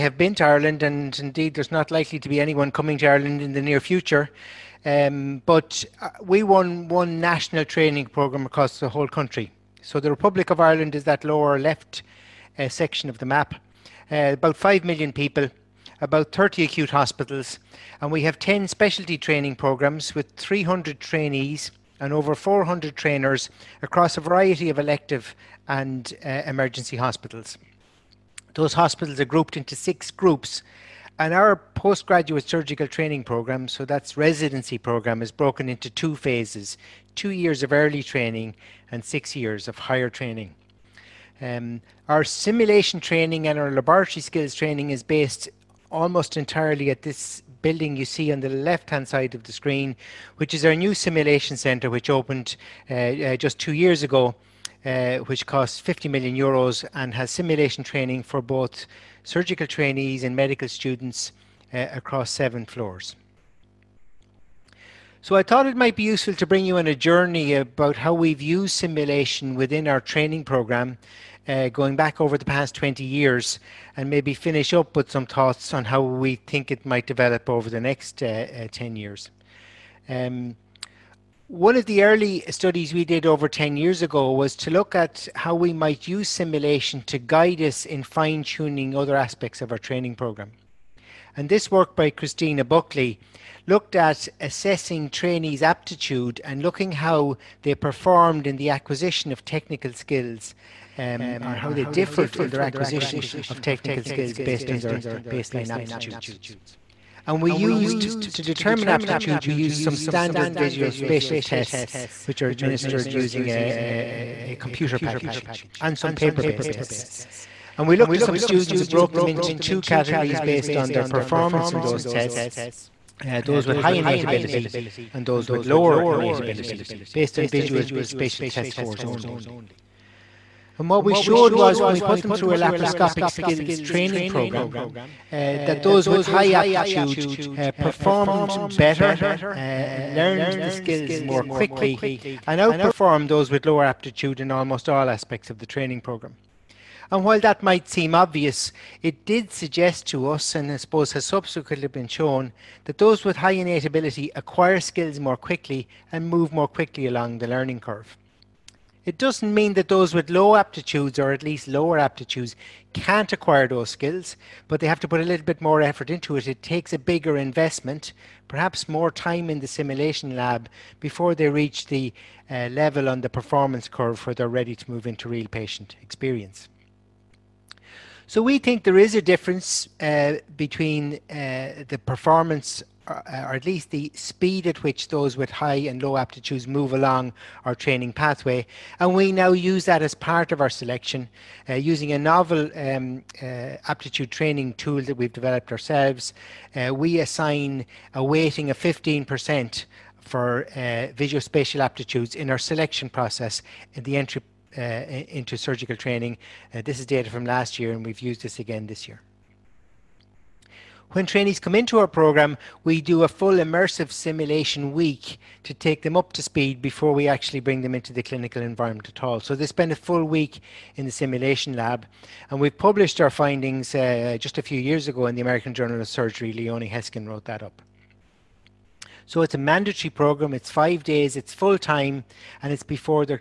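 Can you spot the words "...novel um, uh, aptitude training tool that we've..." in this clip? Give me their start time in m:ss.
3:12.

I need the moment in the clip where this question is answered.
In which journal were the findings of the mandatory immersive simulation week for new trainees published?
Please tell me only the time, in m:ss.
3:45.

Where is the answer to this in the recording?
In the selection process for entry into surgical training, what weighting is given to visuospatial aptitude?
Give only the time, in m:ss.
3:18.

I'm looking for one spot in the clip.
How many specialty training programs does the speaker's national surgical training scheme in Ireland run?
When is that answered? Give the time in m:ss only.
0:18.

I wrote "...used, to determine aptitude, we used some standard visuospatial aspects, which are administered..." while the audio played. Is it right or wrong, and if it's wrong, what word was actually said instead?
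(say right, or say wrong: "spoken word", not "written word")
wrong: "tests", not "aspects".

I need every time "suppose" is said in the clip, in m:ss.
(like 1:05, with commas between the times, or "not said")
2:30.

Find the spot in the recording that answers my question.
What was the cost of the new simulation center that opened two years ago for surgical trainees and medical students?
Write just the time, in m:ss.
0:55.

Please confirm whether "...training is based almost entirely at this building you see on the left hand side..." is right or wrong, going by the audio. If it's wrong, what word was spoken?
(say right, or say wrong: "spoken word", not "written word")
right.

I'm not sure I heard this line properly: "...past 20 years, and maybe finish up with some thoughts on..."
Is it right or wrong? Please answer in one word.
right.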